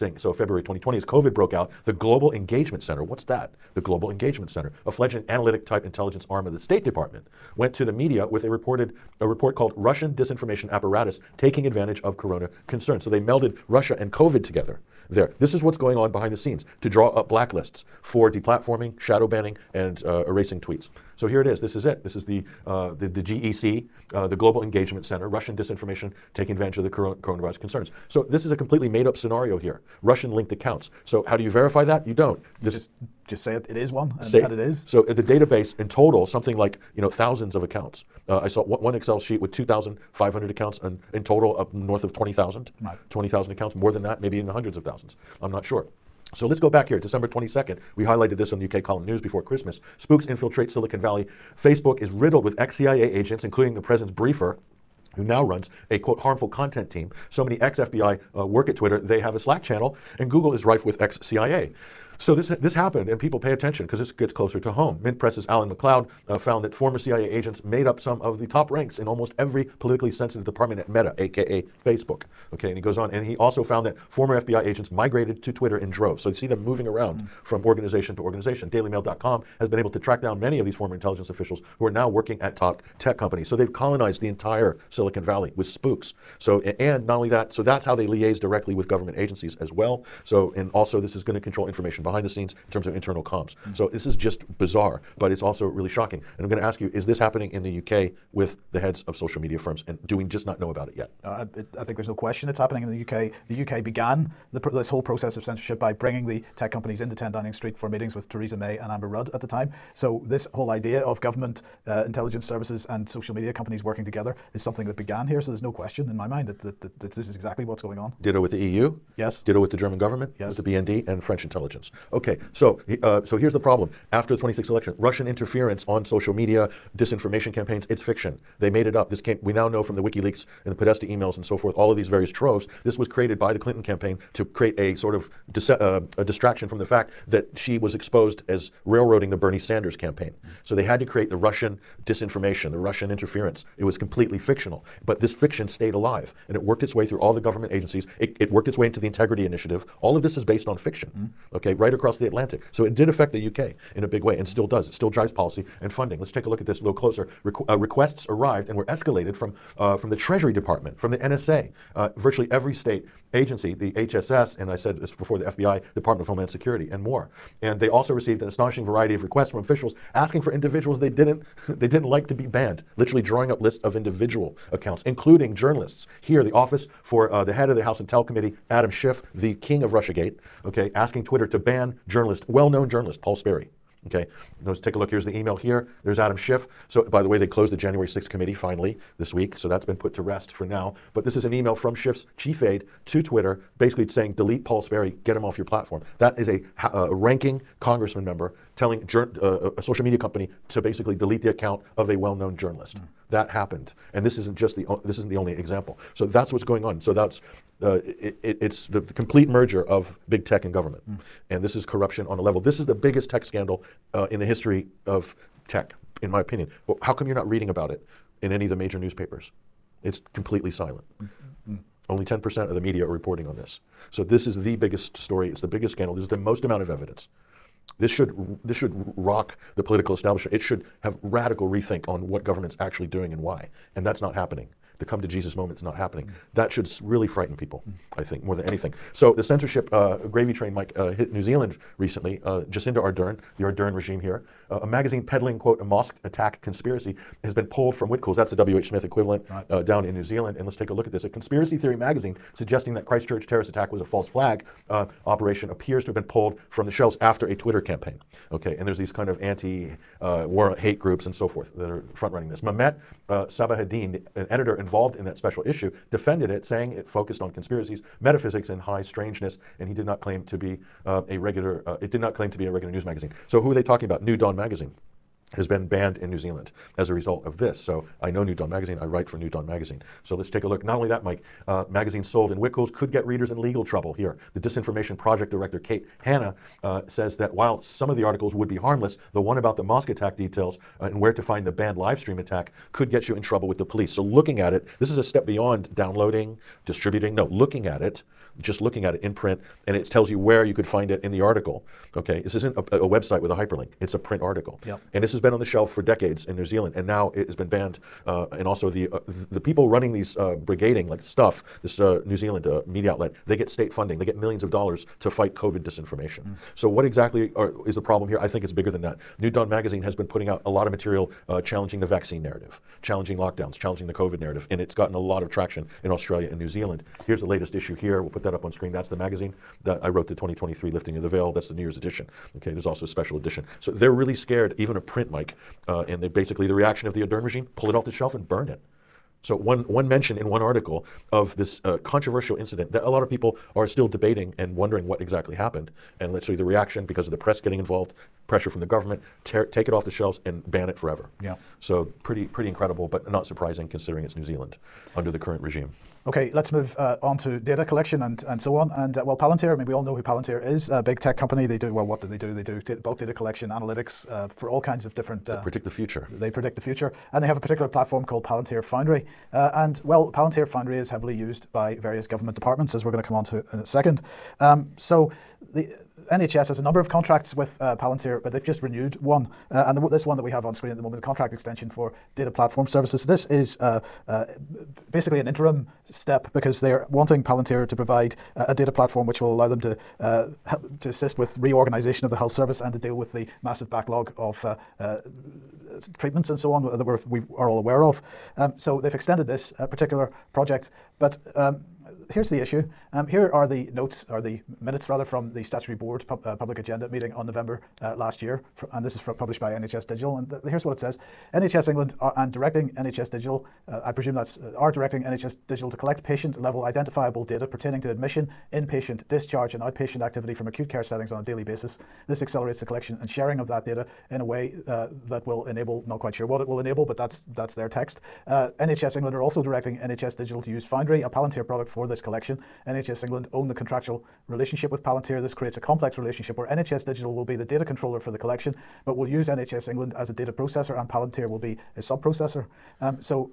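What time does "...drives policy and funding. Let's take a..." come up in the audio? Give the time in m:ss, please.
2:35.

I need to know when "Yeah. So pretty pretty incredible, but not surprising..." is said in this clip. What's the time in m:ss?
5:51.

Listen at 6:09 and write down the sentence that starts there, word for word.
Uh, and well, Palantir Foundry is heavily used by various government departments, as we're going to come on to in a second.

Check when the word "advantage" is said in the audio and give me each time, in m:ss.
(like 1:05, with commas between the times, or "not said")
0:11, 0:26.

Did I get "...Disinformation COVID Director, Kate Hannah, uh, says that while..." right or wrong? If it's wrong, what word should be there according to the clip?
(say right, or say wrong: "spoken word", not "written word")
wrong: "Project", not "COVID".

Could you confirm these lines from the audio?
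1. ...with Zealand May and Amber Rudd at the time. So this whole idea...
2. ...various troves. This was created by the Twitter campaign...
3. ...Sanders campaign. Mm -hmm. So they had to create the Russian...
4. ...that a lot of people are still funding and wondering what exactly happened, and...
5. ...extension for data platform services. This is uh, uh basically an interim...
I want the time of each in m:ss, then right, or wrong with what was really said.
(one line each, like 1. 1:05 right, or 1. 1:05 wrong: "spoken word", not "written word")
1. 1:48 wrong: "Theresa", not "Zealand"
2. 2:12 wrong: "Clinton", not "Twitter"
3. 2:19 right
4. 5:42 wrong: "debating", not "funding"
5. 6:21 right.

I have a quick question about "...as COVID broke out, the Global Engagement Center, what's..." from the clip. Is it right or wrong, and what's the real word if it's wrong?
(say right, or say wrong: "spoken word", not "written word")
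right.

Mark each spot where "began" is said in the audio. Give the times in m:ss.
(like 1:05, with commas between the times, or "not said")
1:43, 1:54.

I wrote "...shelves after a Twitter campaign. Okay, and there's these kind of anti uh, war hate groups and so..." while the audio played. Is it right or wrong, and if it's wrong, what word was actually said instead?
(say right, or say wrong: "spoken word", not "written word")
right.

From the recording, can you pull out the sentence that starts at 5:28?
We'll put that up on screen.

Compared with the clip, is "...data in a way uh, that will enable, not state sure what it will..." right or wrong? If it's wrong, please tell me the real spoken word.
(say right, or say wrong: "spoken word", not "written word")
wrong: "quite", not "state".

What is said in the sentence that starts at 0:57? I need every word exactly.
So many ex FBI uh, work at Twitter, they have a Slack channel, and Google is rife with ex CIA.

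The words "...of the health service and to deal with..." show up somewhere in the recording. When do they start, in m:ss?
6:32.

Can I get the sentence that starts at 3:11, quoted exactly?
But this is an email from Schiff's chief aide to Twitter, basically saying, delete Paul Sperry, get him off your platform.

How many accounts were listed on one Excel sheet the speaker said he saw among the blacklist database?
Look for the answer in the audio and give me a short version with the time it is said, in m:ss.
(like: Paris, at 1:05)
2,500, at 0:39.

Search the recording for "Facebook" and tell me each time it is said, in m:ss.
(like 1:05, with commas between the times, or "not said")
0:51, 1:11.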